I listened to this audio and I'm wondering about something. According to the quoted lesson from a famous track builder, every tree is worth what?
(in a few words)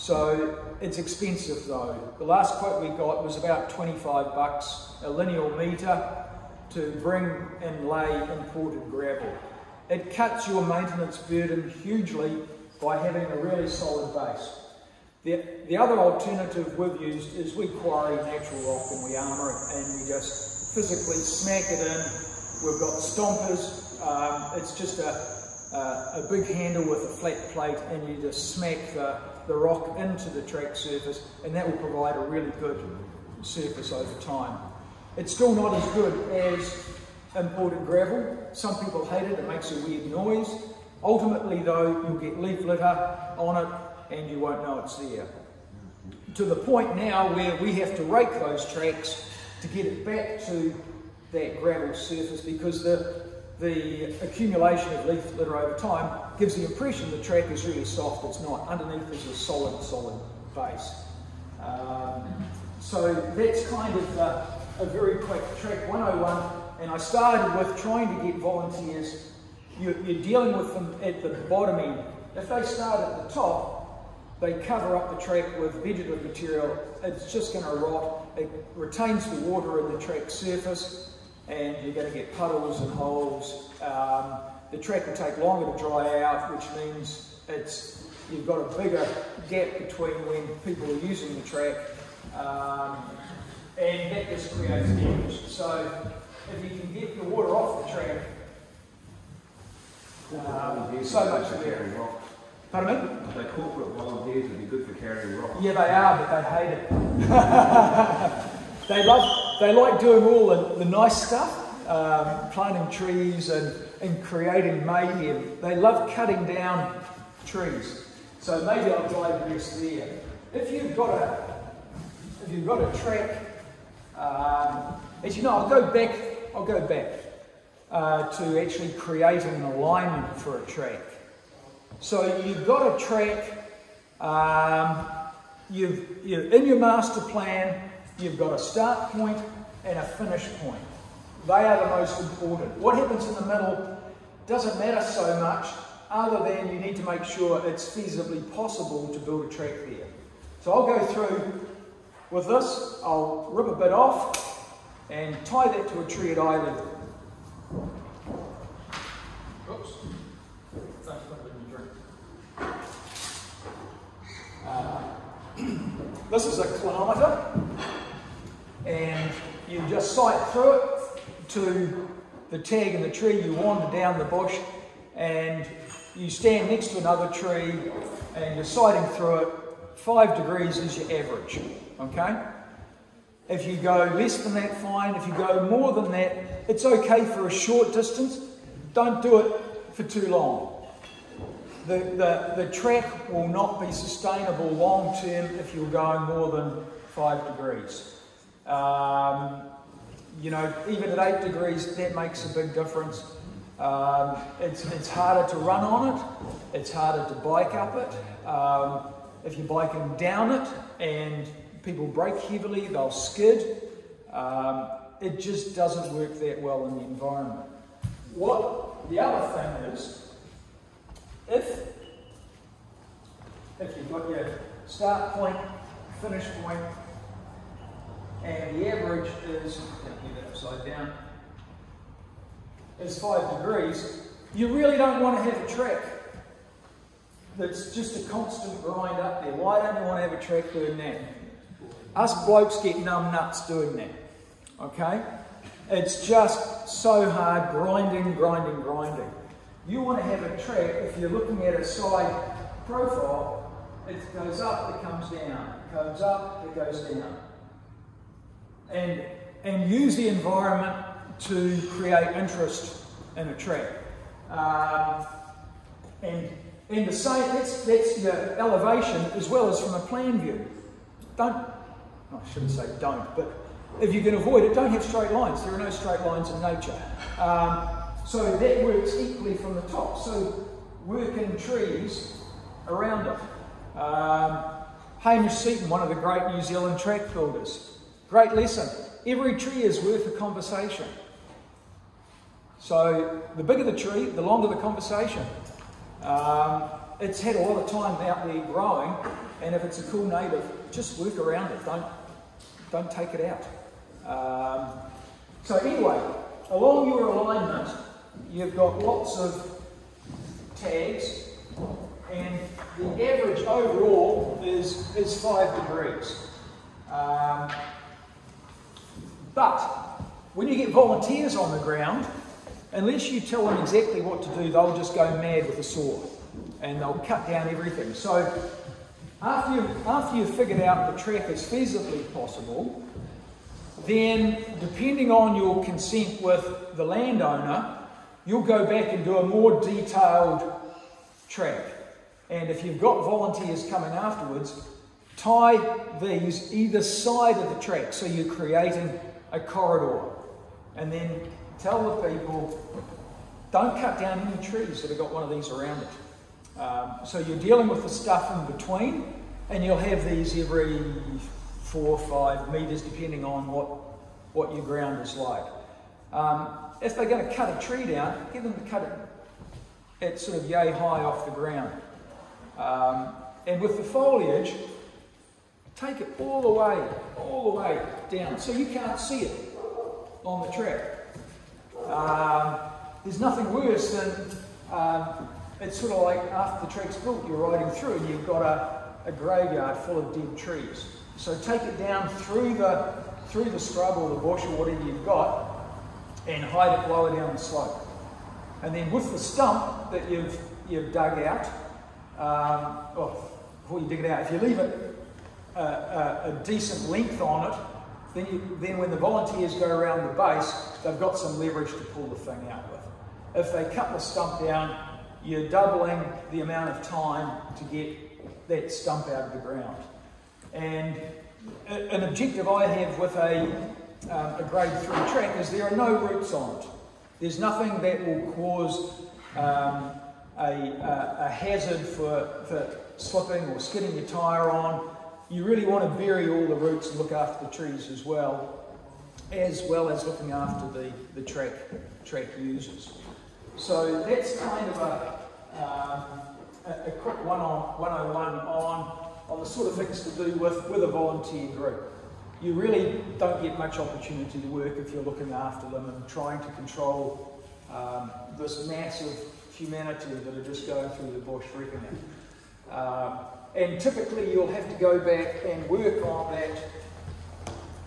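A conversation.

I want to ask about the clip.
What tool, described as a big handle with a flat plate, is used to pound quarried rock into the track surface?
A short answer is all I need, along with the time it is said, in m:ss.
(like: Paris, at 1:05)
Stompers, at 0:22.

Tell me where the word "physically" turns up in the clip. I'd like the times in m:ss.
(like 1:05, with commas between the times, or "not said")
0:20.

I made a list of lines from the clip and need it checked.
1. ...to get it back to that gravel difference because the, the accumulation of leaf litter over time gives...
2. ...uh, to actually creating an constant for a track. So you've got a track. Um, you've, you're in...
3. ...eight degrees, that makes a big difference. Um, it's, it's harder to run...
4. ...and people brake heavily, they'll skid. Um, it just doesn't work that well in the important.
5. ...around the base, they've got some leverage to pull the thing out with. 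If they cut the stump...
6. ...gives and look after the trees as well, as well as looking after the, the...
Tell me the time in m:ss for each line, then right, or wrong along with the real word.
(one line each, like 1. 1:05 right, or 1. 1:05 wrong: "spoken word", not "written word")
1. 0:49 wrong: "surface", not "difference"
2. 2:07 wrong: "alignment", not "constant"
3. 3:21 right
4. 3:31 wrong: "environment", not "important"
5. 6:49 right
6. 7:16 wrong: "routes", not "gives".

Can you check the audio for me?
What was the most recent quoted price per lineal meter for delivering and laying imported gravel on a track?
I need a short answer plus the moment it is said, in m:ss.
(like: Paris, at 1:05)
$25, at 0:03.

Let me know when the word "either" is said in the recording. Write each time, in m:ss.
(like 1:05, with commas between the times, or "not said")
2:36, 5:46.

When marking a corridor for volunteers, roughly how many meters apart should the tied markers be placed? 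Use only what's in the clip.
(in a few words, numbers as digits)
4 or 5 meters.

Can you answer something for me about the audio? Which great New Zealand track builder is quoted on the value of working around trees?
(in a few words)
Hamish Seaton.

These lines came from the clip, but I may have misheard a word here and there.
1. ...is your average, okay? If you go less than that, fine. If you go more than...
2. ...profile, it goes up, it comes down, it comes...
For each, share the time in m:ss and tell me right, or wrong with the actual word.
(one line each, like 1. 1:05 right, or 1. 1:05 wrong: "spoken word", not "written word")
1. 3:00 right
2. 4:12 right.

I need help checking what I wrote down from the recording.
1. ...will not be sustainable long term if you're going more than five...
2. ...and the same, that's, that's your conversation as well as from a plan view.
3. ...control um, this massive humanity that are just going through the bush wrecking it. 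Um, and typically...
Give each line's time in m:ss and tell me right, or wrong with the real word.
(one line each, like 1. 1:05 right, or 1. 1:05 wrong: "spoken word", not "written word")
1. 3:13 right
2. 4:26 wrong: "elevation", not "conversation"
3. 7:36 right.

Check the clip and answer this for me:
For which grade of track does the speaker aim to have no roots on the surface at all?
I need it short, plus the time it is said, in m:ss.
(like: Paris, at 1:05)
Grade 3, at 7:04.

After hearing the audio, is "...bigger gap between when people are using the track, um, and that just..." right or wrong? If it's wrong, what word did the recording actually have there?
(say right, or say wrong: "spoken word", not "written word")
right.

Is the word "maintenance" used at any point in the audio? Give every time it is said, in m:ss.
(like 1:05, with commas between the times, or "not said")
0:10.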